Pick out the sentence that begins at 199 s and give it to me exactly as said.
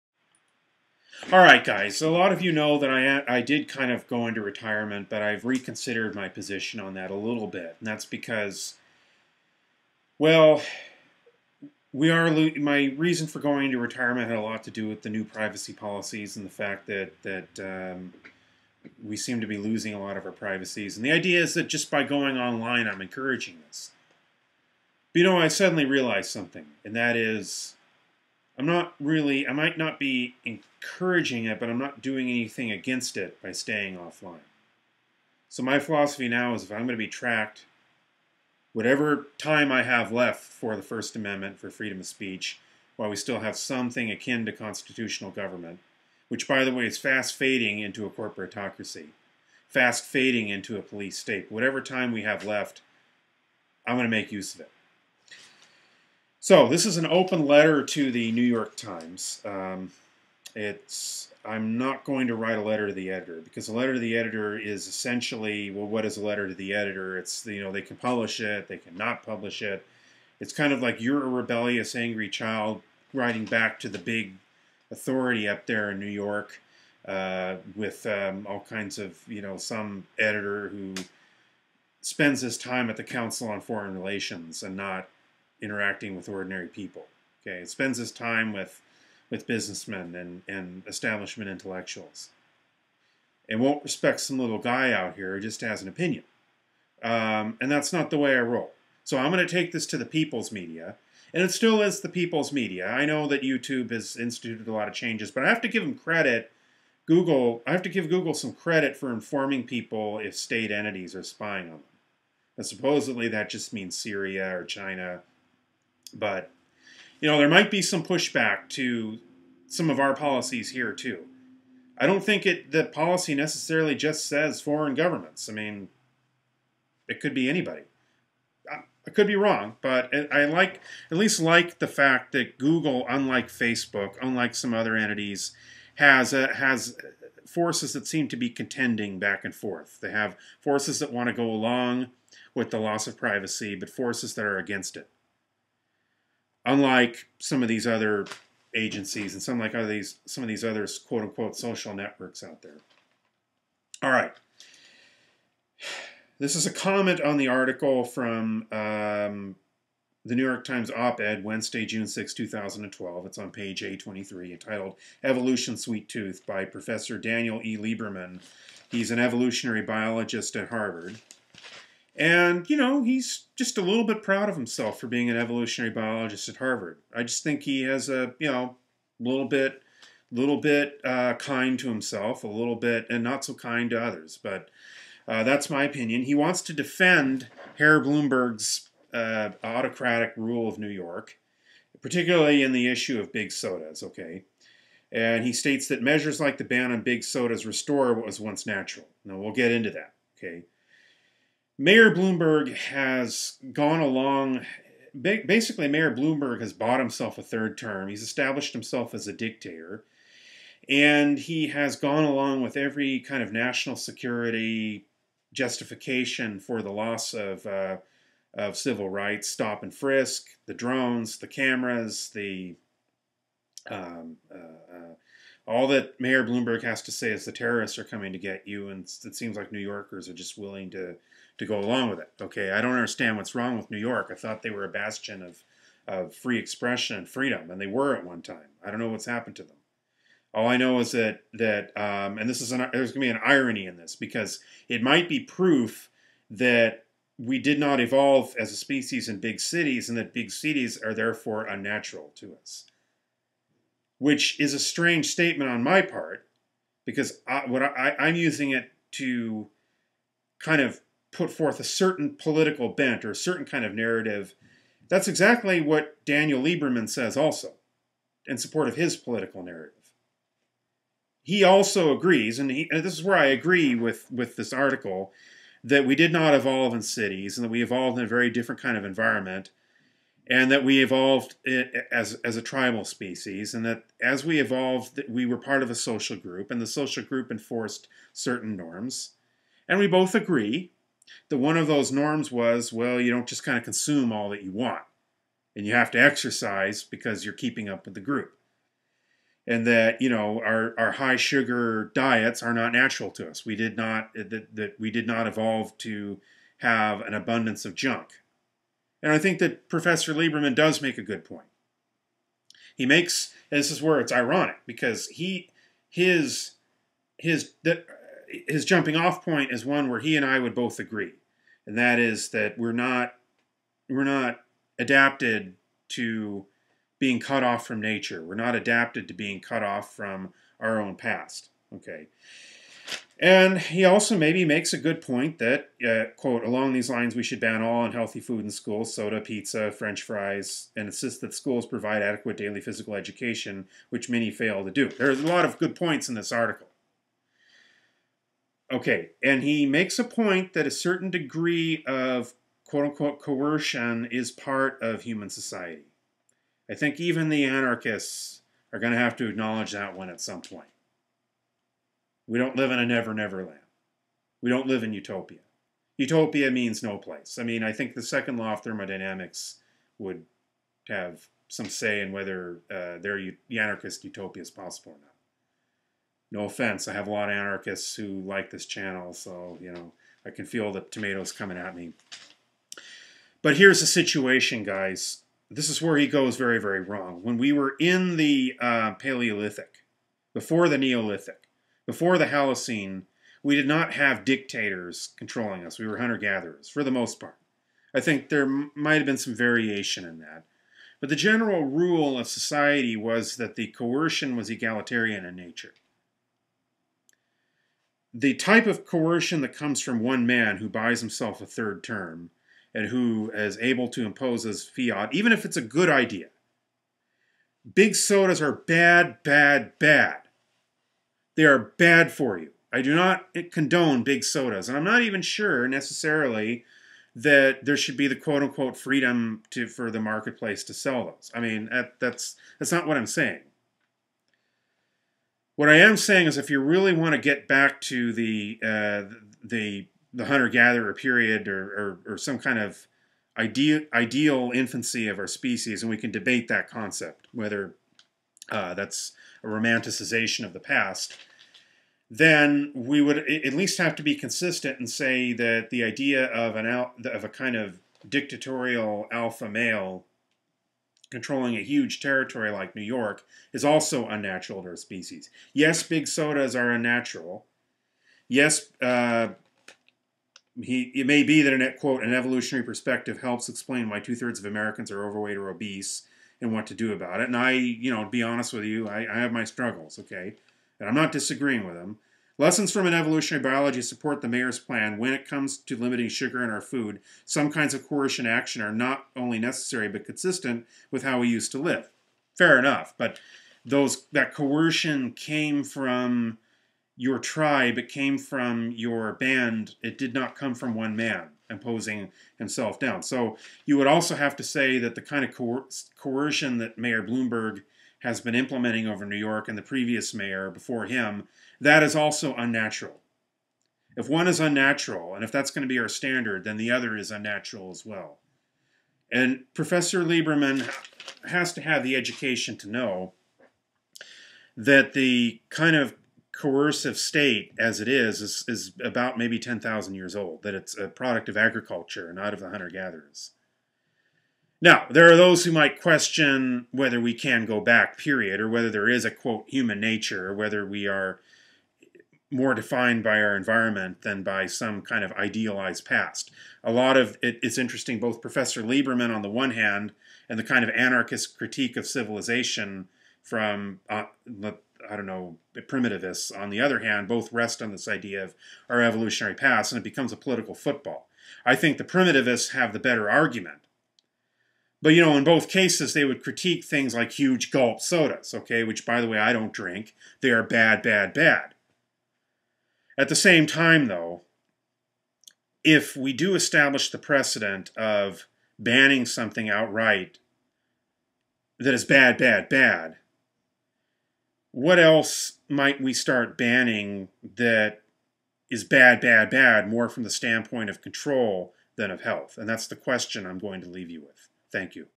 Now, we'll get into that, okay?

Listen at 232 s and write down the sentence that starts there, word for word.
Okay, I don't understand what's wrong with New York.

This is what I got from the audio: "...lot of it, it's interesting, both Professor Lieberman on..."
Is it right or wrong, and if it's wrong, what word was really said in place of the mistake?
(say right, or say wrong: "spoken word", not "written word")
right.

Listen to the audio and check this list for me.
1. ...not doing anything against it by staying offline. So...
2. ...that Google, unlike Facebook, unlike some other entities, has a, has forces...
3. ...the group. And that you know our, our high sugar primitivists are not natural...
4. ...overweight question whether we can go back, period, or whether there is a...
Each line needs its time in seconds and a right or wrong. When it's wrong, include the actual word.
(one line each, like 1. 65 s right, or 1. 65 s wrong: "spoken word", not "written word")
1. 31 s right
2. 132 s right
3. 298 s wrong: "diets", not "primitivists"
4. 535 s wrong: "might", not "overweight".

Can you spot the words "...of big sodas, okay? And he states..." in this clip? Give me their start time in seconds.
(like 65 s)
193 s.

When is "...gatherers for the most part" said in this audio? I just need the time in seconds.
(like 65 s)
396 s.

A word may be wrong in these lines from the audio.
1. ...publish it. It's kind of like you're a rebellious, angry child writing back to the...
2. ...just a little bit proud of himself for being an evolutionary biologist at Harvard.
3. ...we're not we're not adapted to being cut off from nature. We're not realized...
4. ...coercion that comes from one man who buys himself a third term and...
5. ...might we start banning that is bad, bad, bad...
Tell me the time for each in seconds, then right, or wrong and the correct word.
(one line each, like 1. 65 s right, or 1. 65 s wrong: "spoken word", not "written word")
1. 69 s right
2. 173 s right
3. 322 s wrong: "adapted", not "realized"
4. 409 s right
5. 585 s right.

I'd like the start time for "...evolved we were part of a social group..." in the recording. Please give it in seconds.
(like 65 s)
284 s.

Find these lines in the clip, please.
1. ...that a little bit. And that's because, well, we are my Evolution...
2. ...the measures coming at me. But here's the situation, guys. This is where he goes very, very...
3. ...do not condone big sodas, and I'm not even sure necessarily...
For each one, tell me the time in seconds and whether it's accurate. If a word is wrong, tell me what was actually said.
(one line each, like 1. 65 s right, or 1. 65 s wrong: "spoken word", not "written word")
1. 6 s wrong: "reason", not "Evolution"
2. 380 s wrong: "tomatoes", not "measures"
3. 423 s right.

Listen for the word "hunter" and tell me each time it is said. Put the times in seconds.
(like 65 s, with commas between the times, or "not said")
396 s, 440 s, 532 s.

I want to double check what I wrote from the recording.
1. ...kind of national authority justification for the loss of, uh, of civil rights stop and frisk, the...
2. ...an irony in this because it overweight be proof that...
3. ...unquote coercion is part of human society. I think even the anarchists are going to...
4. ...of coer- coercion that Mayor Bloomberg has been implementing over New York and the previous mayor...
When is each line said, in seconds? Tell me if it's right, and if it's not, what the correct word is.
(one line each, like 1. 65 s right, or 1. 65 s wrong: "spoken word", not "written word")
1. 213 s wrong: "security", not "authority"
2. 243 s wrong: "might", not "overweight"
3. 353 s right
4. 505 s right.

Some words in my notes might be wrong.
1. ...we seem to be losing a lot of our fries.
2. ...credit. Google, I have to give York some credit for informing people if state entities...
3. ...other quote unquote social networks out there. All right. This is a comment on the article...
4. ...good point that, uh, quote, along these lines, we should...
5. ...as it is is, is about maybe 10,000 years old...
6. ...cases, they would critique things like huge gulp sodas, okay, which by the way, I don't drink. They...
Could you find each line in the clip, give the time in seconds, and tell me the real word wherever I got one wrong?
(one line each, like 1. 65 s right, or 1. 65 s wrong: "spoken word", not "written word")
1. 19 s wrong: "privacies", not "fries"
2. 105 s wrong: "Google", not "York"
3. 150 s right
4. 334 s right
5. 527 s right
6. 565 s right.